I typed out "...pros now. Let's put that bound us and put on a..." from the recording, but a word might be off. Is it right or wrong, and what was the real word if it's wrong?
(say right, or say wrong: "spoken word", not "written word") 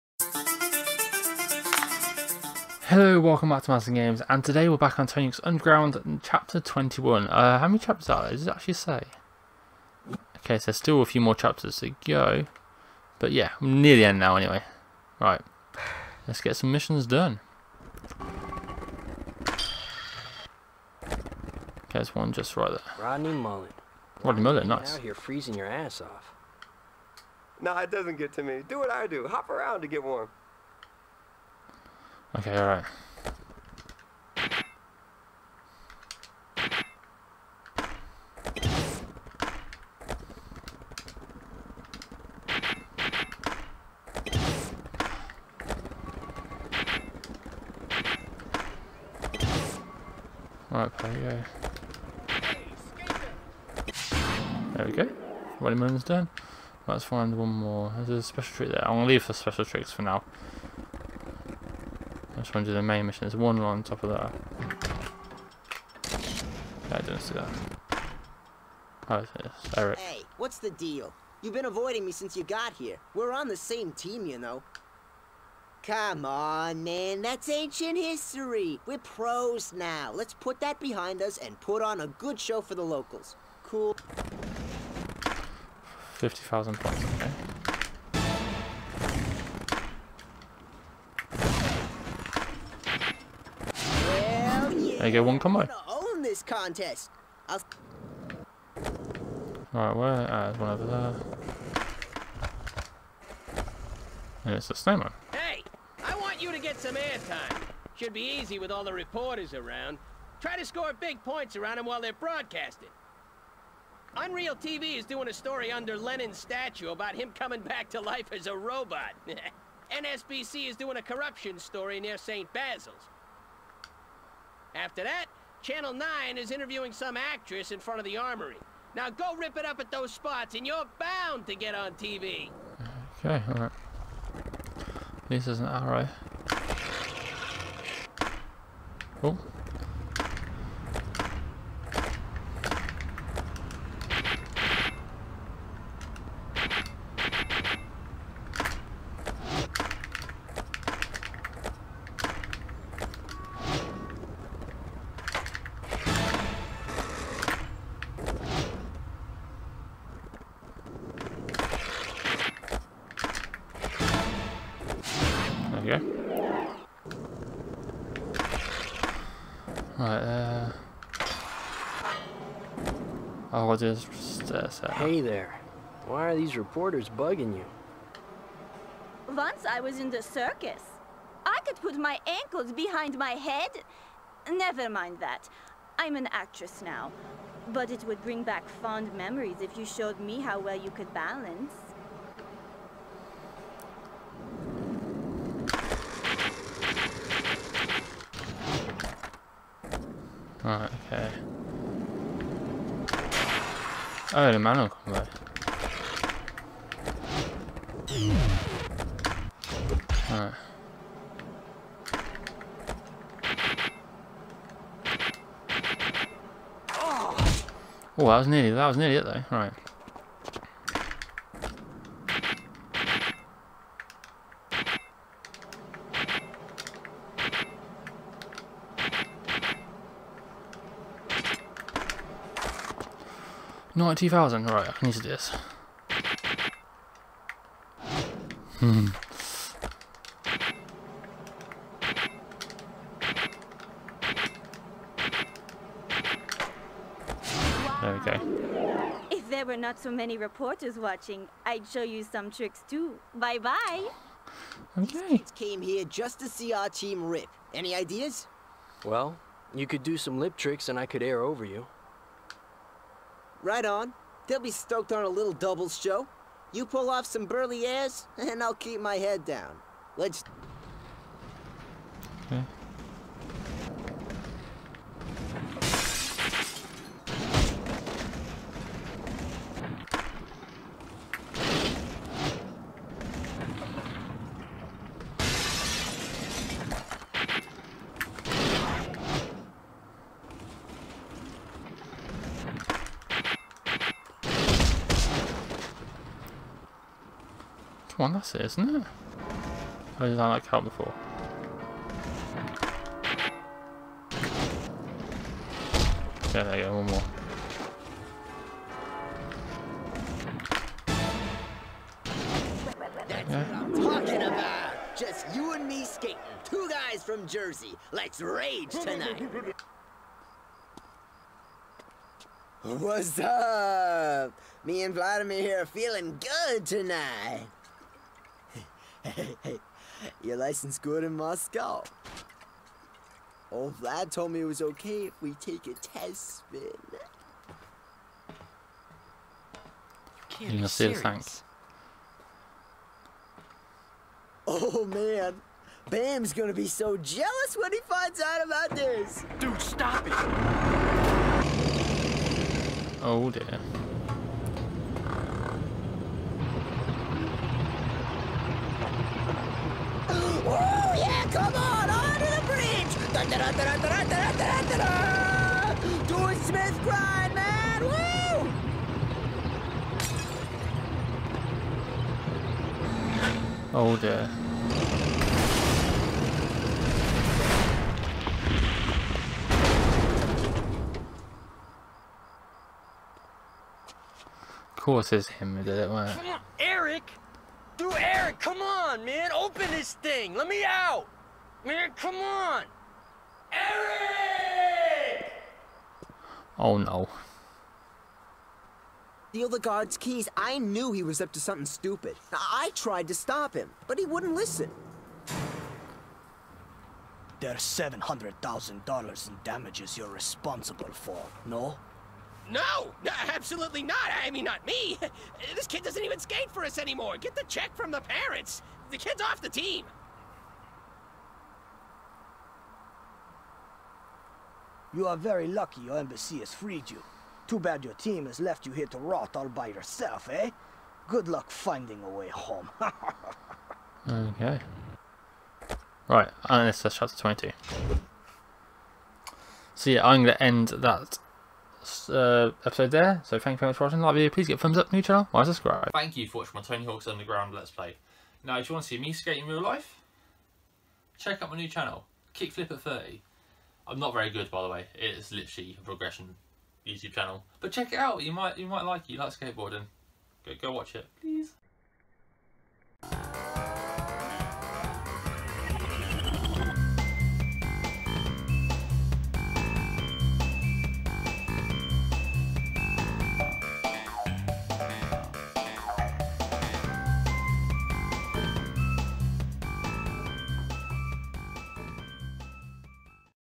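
wrong: "behind", not "bound".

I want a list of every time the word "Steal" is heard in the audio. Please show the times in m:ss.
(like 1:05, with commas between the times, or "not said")
6:39.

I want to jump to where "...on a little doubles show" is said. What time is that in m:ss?
4:25.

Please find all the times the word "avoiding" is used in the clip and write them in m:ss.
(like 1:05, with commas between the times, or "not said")
1:11.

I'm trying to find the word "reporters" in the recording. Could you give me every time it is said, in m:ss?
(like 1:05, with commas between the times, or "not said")
1:48, 2:56, 4:10.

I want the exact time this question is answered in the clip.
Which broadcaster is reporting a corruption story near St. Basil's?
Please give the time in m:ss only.
1:59.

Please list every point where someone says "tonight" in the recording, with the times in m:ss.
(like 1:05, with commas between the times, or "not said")
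5:18, 5:26.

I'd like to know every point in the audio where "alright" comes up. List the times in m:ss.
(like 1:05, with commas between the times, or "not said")
0:32, 2:13.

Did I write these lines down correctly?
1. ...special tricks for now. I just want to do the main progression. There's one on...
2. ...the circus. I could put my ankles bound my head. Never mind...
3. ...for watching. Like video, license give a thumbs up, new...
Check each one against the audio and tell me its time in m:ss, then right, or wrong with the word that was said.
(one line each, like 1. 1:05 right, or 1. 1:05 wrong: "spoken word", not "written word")
1. 0:59 wrong: "mission", not "progression"
2. 3:00 wrong: "behind", not "bound"
3. 7:23 wrong: "please", not "license".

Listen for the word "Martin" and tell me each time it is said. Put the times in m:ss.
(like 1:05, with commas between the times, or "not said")
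0:03.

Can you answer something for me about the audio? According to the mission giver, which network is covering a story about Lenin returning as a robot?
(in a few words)
Unreal TV.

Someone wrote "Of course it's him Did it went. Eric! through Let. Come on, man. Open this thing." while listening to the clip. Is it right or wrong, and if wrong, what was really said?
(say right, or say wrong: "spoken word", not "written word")
wrong: "Eric", not "Let".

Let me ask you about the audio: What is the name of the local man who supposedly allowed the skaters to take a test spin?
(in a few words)
Vladimir.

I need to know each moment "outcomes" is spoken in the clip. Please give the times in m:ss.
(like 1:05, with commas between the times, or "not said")
not said.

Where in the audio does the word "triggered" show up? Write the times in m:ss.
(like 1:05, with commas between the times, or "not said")
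not said.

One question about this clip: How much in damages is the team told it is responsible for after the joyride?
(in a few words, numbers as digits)
$700,000.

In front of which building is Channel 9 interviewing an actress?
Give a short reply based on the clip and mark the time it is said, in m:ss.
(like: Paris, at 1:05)
the armory, at 2:08.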